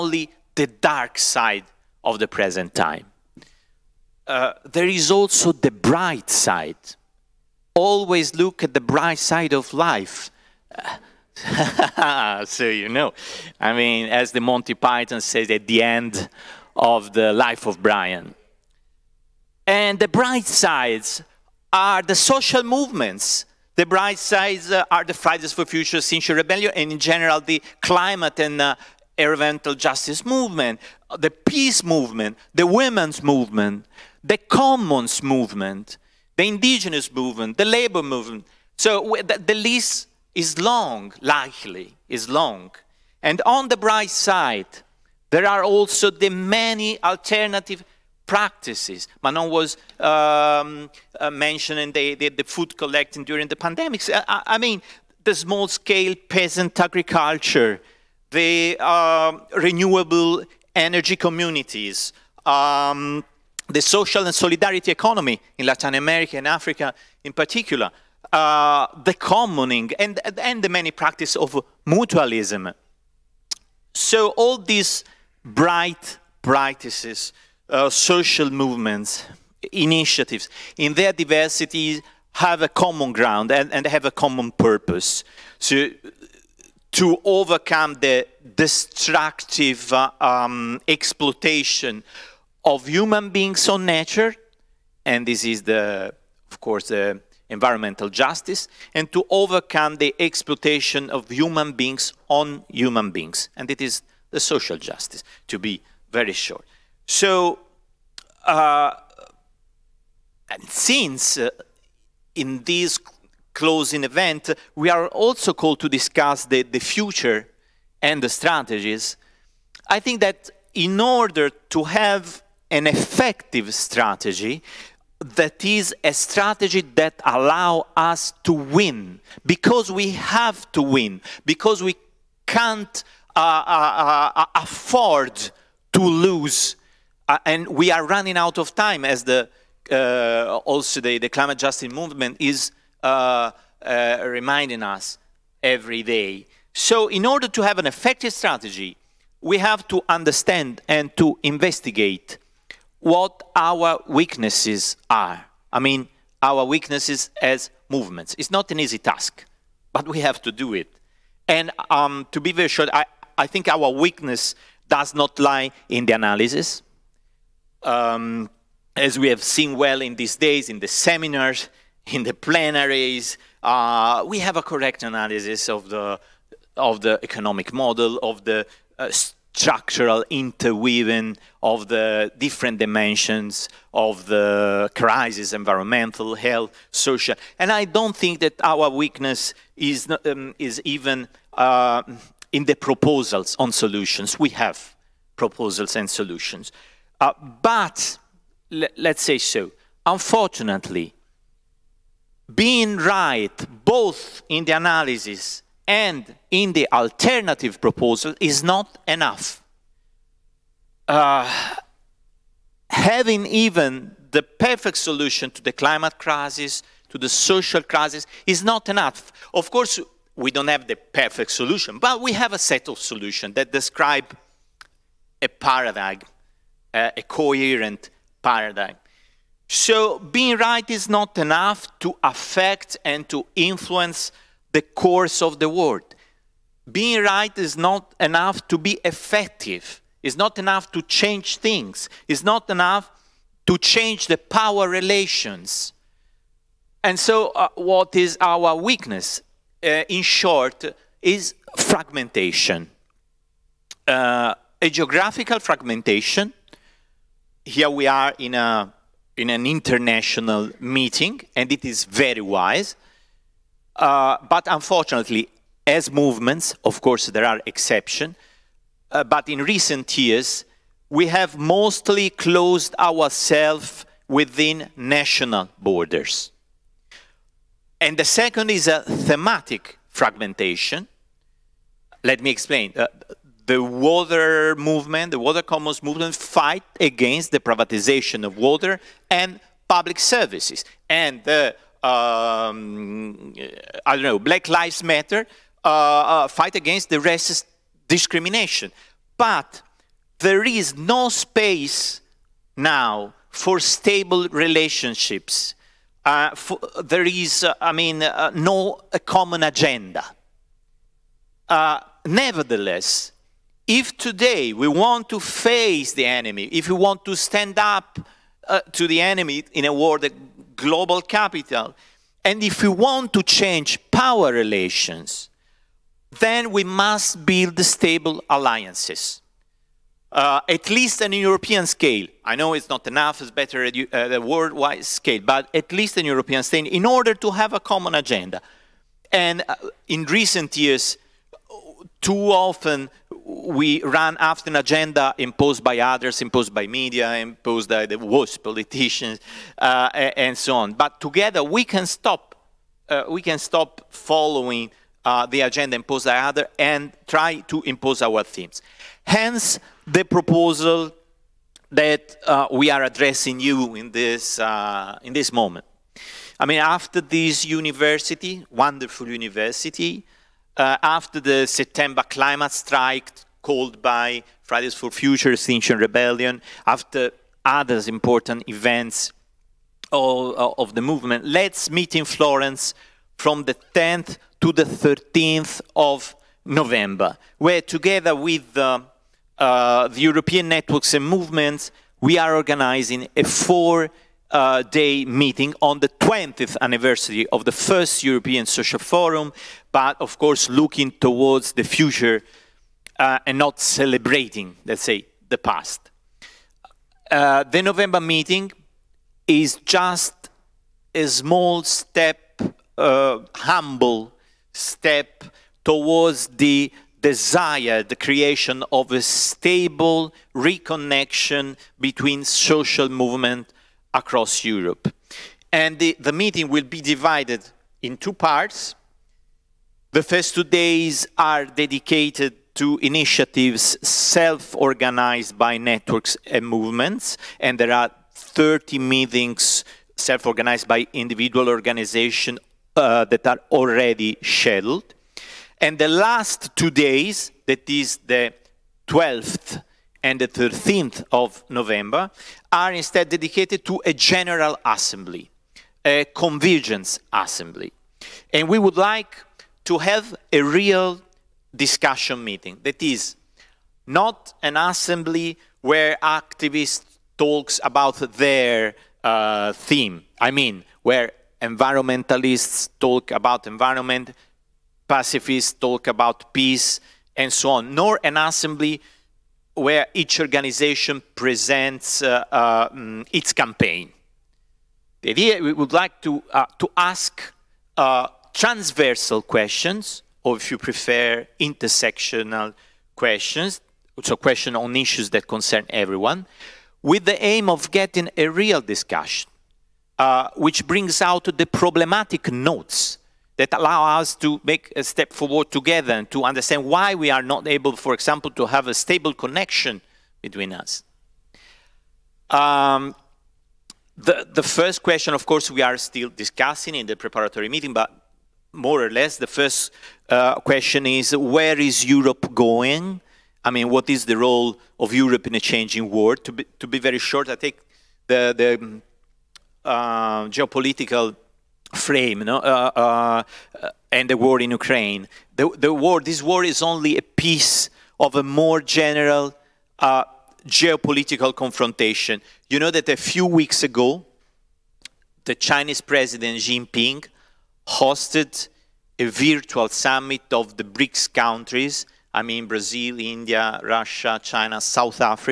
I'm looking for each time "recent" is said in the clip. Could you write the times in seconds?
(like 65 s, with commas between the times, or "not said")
269 s, 340 s.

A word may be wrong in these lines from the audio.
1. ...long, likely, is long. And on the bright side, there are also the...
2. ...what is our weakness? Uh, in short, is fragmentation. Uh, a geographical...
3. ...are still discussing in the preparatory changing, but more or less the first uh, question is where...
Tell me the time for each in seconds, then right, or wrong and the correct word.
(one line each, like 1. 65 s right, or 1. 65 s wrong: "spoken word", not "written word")
1. 40 s right
2. 247 s right
3. 515 s wrong: "meeting", not "changing".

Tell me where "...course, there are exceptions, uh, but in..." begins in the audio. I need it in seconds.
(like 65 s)
267 s.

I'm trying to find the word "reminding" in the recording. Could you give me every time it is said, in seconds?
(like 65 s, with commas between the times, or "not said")
144 s.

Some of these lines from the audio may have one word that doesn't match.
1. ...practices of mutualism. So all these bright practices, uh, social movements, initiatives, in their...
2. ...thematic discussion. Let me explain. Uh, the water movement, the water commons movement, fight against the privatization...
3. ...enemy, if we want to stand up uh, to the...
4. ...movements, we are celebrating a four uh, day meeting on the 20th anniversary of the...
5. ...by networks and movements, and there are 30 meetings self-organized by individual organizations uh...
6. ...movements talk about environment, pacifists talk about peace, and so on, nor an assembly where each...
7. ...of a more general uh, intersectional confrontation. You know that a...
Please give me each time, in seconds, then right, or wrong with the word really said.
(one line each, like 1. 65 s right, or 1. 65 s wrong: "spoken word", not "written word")
1. 70 s right
2. 279 s wrong: "fragmentation", not "discussion"
3. 316 s right
4. 391 s wrong: "organizing", not "celebrating"
5. 435 s right
6. 471 s wrong: "environmentalists", not "movements"
7. 538 s wrong: "geopolitical", not "intersectional".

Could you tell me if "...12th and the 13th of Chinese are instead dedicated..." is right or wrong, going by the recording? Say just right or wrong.
wrong.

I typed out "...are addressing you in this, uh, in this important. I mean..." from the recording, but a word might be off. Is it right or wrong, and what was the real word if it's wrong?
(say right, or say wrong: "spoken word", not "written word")
wrong: "moment", not "important".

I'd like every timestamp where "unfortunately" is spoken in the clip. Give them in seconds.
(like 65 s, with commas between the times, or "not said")
200 s, 264 s.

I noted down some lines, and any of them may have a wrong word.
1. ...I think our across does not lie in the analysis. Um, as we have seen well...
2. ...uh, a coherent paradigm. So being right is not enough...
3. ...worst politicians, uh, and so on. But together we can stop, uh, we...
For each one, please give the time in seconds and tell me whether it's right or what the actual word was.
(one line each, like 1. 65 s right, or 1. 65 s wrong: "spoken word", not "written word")
1. 163 s wrong: "weakness", not "across"
2. 226 s right
3. 348 s right.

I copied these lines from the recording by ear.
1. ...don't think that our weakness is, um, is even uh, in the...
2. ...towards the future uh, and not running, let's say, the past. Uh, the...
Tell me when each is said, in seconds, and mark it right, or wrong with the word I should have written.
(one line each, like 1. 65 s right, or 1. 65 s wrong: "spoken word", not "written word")
1. 187 s right
2. 401 s wrong: "celebrating", not "running".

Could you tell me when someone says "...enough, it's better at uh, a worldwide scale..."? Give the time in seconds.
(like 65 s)
333 s.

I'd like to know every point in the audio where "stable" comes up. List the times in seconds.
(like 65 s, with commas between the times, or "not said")
303 s, 327 s, 419 s, 508 s.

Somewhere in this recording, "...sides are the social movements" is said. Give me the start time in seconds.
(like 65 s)
20 s.